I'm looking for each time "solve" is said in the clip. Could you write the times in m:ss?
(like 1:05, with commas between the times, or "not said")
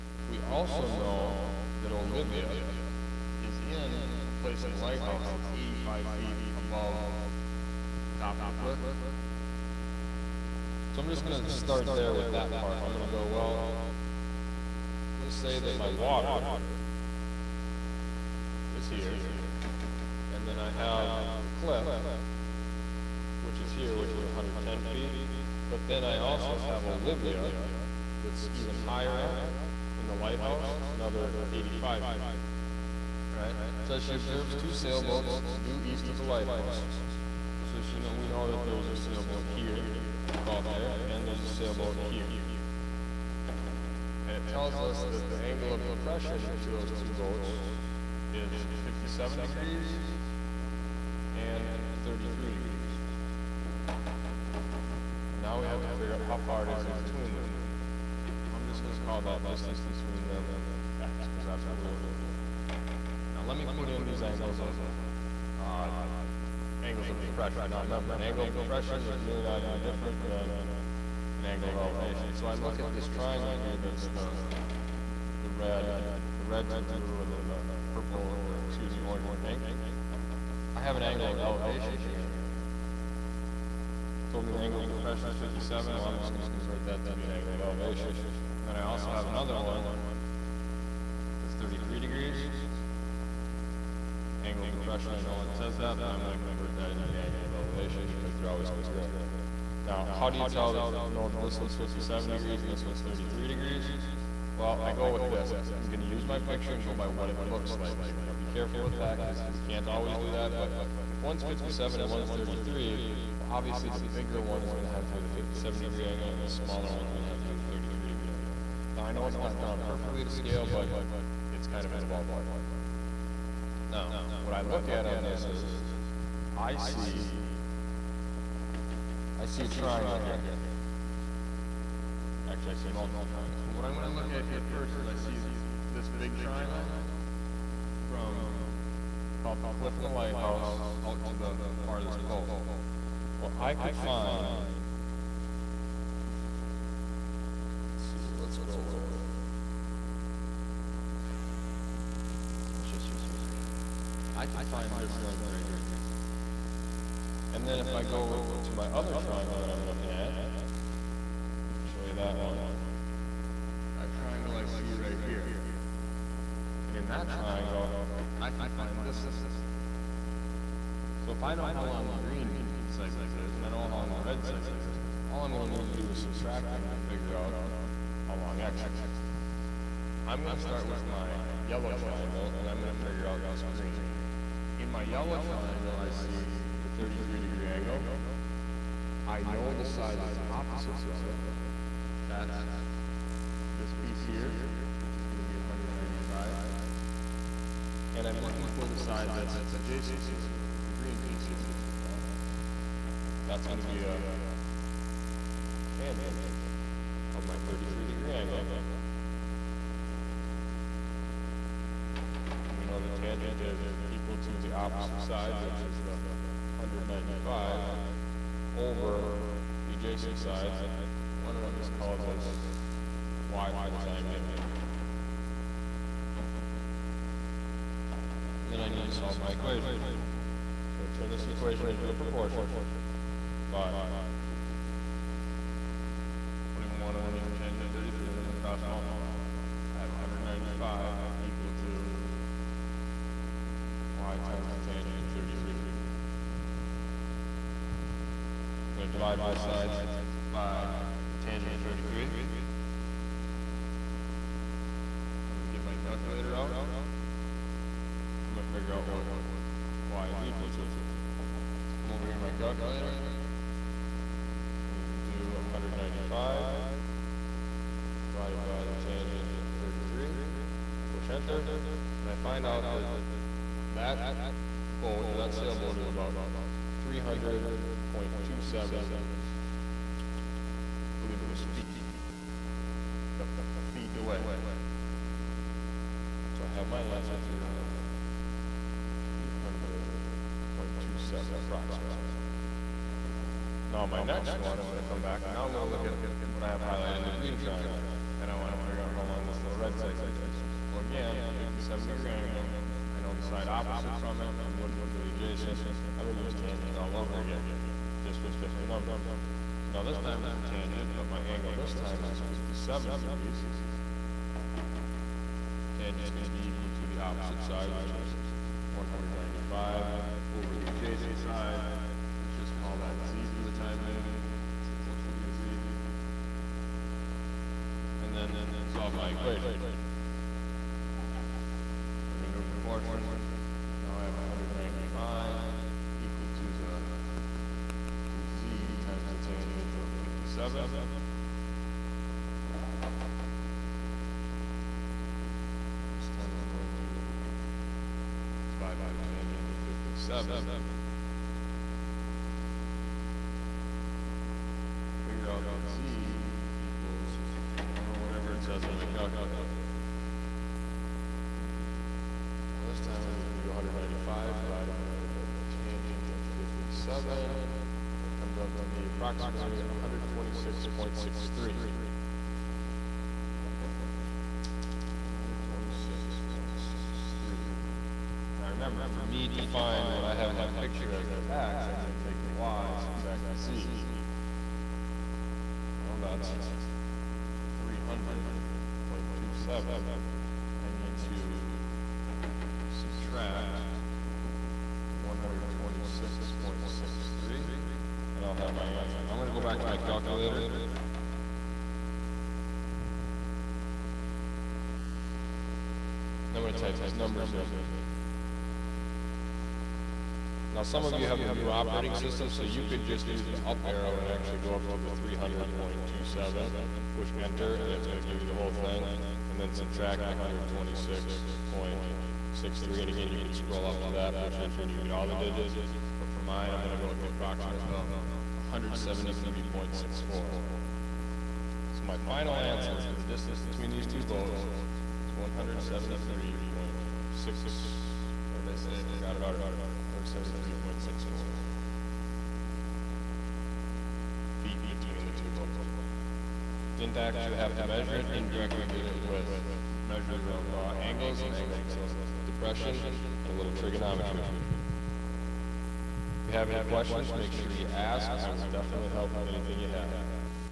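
3:49, 5:28.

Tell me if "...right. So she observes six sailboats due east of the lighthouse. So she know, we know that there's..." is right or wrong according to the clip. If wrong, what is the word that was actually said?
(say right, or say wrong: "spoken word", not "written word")
wrong: "two", not "six".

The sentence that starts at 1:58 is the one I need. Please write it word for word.
Now, I know it's not drawn perfectly to scale, but it's kind of in the ballpark.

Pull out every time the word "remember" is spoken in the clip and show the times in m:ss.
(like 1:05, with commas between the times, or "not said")
1:07, 6:18.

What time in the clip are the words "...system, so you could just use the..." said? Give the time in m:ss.
6:52.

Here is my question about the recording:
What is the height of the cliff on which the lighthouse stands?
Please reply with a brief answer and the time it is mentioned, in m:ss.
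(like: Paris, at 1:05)
110 feet, at 0:24.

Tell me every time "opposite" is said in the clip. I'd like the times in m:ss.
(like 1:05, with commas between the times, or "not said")
3:10, 3:34, 5:03, 5:17.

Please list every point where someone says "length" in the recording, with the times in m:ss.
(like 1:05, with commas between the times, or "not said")
2:35, 2:49.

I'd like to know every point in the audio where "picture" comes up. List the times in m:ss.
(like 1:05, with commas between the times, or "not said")
1:46, 6:20.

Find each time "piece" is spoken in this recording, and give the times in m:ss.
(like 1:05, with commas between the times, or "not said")
3:14, 3:21.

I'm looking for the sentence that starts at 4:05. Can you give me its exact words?
I'm gonna divide both sides by the tangent of thirty-three.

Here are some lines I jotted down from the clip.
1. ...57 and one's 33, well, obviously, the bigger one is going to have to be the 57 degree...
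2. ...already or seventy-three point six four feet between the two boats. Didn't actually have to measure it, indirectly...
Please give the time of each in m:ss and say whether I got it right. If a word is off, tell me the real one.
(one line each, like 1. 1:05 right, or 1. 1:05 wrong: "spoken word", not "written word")
1. 1:51 right
2. 7:19 right.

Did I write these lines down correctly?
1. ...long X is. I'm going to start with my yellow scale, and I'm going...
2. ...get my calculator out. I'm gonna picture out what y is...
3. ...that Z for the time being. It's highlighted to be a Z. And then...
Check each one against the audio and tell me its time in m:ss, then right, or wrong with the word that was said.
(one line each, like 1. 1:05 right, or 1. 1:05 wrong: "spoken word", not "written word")
1. 2:58 wrong: "triangle", not "scale"
2. 4:15 wrong: "figure", not "picture"
3. 5:23 wrong: "supposed", not "highlighted".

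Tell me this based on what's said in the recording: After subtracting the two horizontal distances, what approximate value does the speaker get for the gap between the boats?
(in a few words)
173.64.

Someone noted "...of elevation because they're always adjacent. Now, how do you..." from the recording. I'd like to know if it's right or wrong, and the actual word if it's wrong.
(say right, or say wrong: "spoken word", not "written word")
wrong: "congruent", not "adjacent".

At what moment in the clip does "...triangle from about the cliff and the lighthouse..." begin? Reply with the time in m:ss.
2:16.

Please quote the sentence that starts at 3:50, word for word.
So I turn this equation into a proportion five.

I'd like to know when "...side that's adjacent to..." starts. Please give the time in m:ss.
3:18.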